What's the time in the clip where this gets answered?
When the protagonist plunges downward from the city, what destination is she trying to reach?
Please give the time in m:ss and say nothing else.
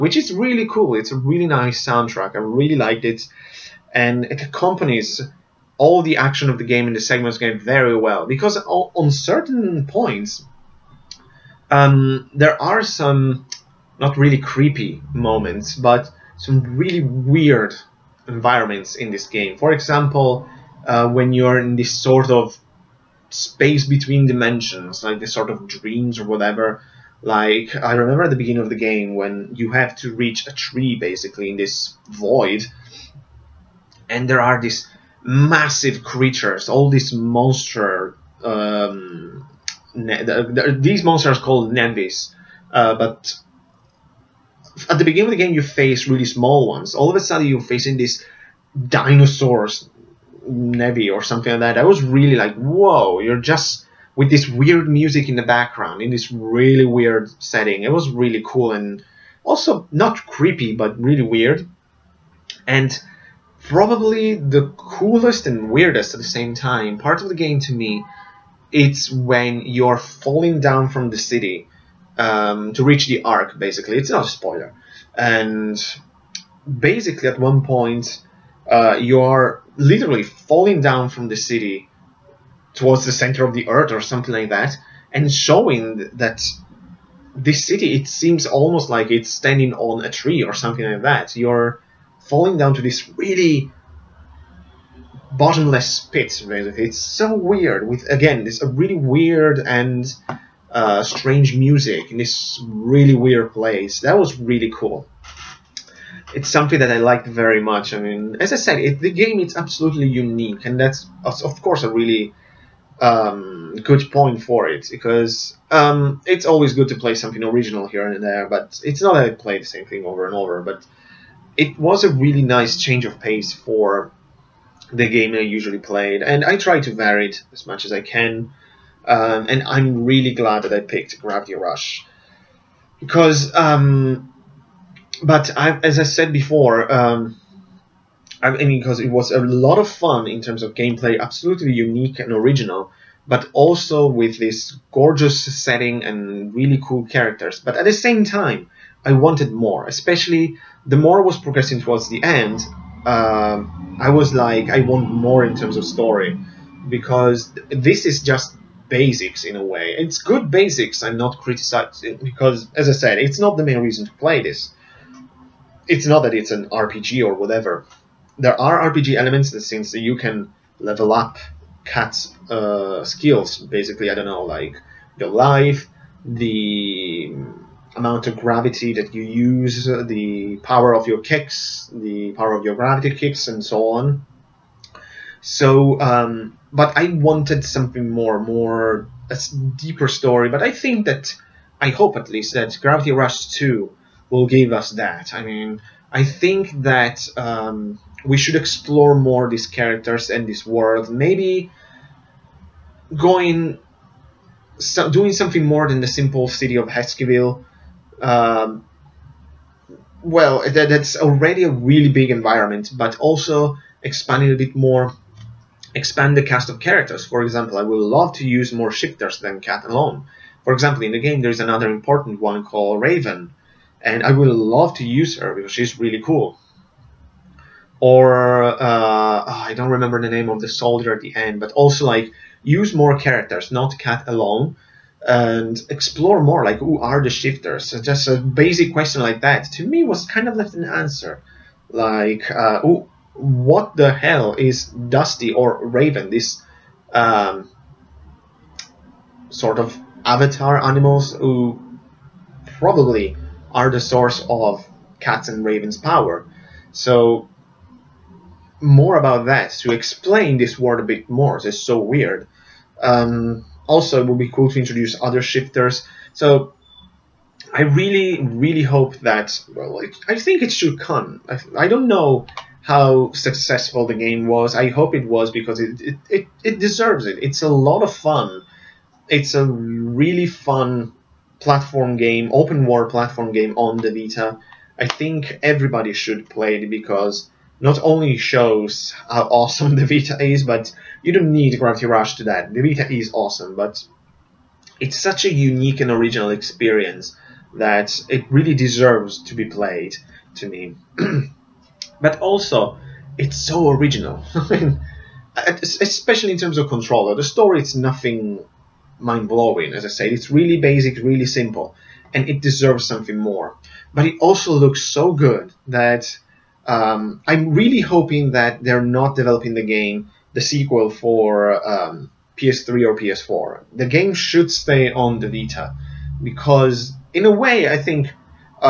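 1:13.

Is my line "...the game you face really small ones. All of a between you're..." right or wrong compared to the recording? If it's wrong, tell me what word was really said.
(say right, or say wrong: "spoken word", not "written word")
wrong: "sudden", not "between".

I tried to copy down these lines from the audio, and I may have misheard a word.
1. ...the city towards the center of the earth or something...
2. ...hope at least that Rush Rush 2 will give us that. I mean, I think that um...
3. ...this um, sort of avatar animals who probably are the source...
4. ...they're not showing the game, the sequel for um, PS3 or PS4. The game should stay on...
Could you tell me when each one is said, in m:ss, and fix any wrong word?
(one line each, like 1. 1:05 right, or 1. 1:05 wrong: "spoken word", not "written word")
1. 1:21 right
2. 3:11 wrong: "Gravity", not "Rush"
3. 4:06 right
4. 5:18 wrong: "developing", not "showing".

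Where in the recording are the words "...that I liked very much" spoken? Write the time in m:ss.
1:46.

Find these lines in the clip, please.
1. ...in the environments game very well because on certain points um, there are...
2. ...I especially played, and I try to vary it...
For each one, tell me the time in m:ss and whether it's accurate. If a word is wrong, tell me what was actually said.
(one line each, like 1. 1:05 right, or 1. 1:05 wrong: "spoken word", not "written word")
1. 0:06 wrong: "segments", not "environments"
2. 2:05 wrong: "usually", not "especially".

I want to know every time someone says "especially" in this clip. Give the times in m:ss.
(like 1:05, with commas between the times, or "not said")
2:29, 5:05.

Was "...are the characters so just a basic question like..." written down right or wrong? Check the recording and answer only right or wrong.
wrong.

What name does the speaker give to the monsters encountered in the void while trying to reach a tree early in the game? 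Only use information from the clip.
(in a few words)
Nenvis.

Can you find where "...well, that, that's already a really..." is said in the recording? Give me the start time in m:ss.
3:30.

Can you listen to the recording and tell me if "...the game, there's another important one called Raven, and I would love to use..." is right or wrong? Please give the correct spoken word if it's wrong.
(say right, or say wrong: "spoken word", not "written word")
right.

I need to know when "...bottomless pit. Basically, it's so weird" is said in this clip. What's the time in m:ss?
1:35.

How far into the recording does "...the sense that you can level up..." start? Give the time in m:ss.
2:49.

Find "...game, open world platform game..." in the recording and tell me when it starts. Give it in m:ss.
4:42.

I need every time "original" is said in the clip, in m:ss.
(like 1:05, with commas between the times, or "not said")
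1:57, 2:22, 4:56, 5:03.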